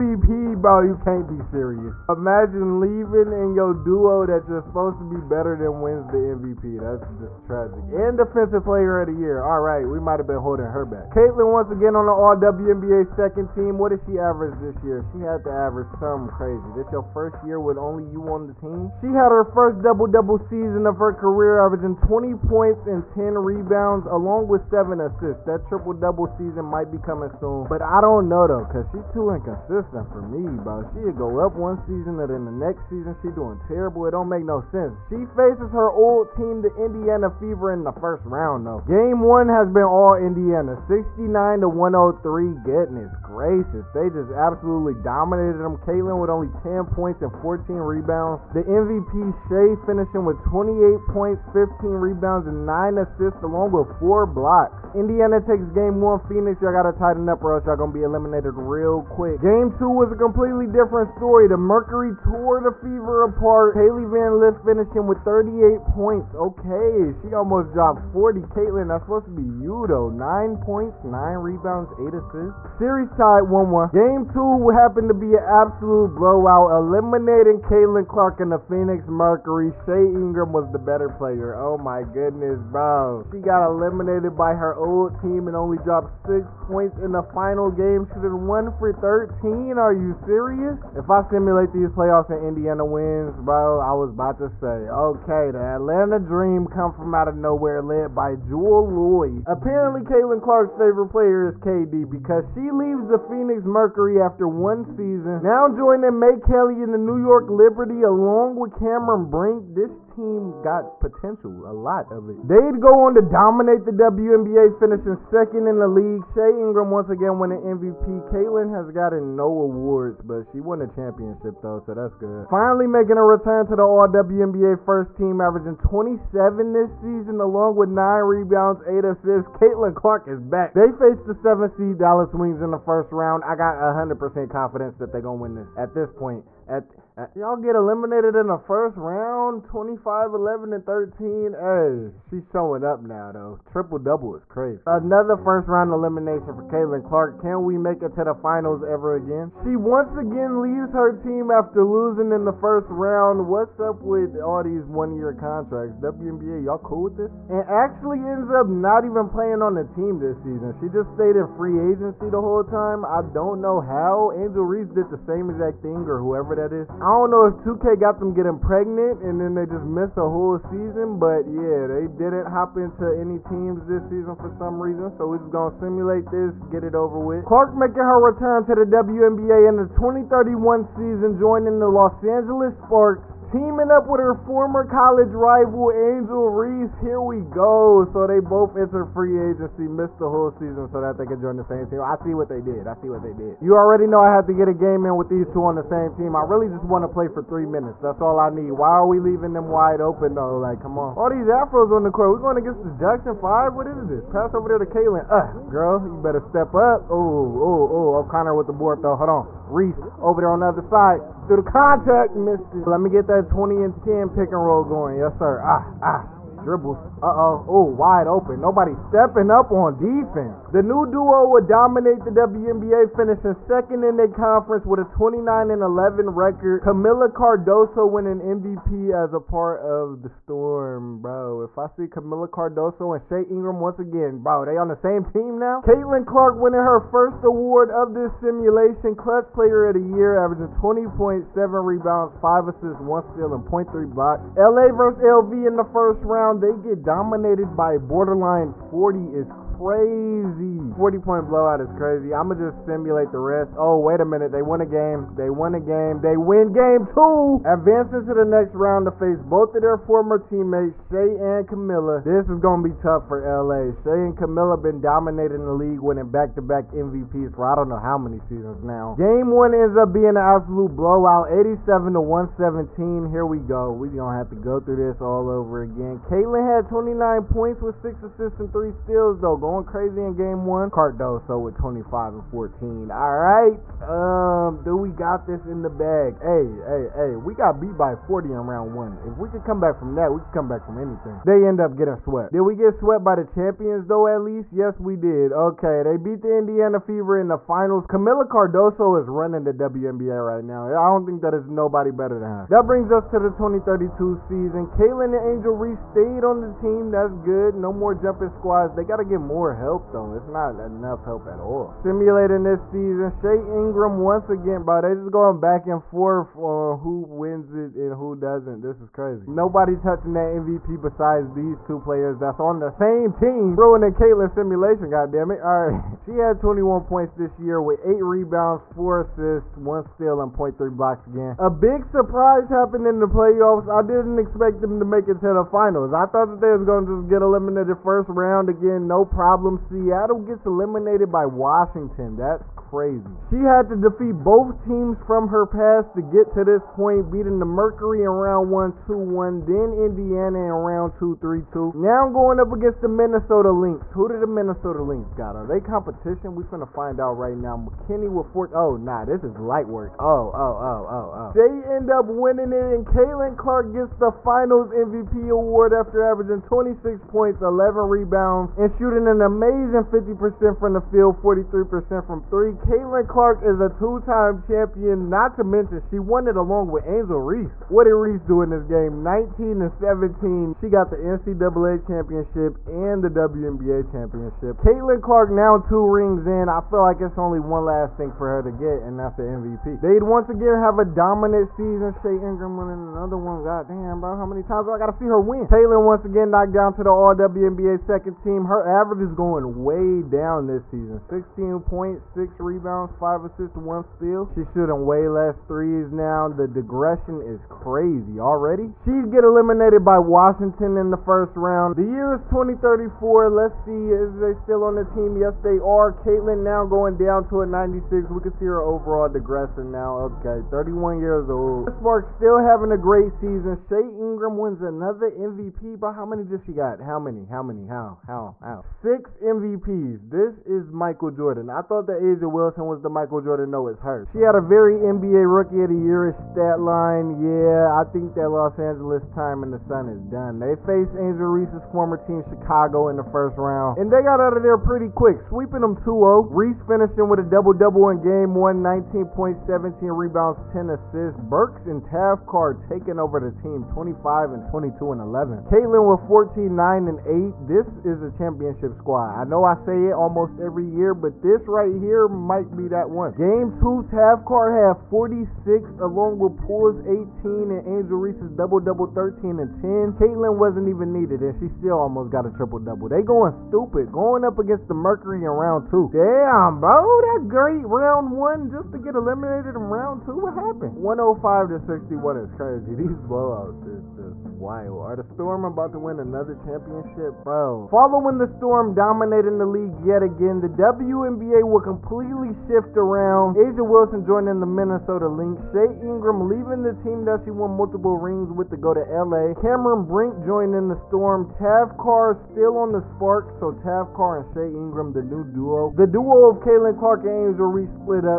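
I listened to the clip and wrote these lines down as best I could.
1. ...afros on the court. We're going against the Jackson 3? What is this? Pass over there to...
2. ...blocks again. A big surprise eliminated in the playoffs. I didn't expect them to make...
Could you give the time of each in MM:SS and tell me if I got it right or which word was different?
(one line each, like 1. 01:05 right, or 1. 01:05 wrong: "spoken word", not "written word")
1. 03:21 wrong: "5", not "3"
2. 05:30 wrong: "happened", not "eliminated".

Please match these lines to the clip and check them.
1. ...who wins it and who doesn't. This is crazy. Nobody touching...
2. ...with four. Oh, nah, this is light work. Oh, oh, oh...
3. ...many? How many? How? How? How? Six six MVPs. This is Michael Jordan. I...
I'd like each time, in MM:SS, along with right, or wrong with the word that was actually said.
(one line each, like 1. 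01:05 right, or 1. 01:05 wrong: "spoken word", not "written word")
1. 05:16 right
2. 05:58 right
3. 07:07 right.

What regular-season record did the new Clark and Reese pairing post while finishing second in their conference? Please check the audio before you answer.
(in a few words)
29-11.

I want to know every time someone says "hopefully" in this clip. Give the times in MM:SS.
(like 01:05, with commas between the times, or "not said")
not said.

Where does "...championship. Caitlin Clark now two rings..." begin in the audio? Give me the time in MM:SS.
06:24.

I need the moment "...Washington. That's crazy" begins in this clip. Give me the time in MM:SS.
05:41.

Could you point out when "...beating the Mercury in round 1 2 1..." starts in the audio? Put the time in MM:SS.
05:47.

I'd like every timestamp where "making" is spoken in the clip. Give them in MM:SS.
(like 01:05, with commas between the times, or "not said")
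02:02, 02:57.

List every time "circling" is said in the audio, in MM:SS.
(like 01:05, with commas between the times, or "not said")
not said.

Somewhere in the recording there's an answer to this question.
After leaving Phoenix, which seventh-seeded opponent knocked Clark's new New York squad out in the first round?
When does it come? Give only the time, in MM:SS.
02:11.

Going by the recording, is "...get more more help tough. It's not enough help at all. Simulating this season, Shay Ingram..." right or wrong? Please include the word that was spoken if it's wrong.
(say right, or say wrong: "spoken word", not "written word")
wrong: "though", not "tough".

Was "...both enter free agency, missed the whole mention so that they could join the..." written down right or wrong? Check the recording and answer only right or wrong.
wrong.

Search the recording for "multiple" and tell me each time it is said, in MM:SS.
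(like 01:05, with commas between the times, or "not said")
08:17.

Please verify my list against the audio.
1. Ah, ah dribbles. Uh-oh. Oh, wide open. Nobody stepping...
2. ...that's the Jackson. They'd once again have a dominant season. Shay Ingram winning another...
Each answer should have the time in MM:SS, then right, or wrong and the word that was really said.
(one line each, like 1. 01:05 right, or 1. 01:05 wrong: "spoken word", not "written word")
1. 03:35 right
2. 06:29 wrong: "MVP", not "Jackson".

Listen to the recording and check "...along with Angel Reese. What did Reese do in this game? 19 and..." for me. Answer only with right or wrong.
right.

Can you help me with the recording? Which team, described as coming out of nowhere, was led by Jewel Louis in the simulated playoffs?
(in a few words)
Atlanta Dream.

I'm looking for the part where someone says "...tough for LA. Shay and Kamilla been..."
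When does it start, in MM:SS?
04:22.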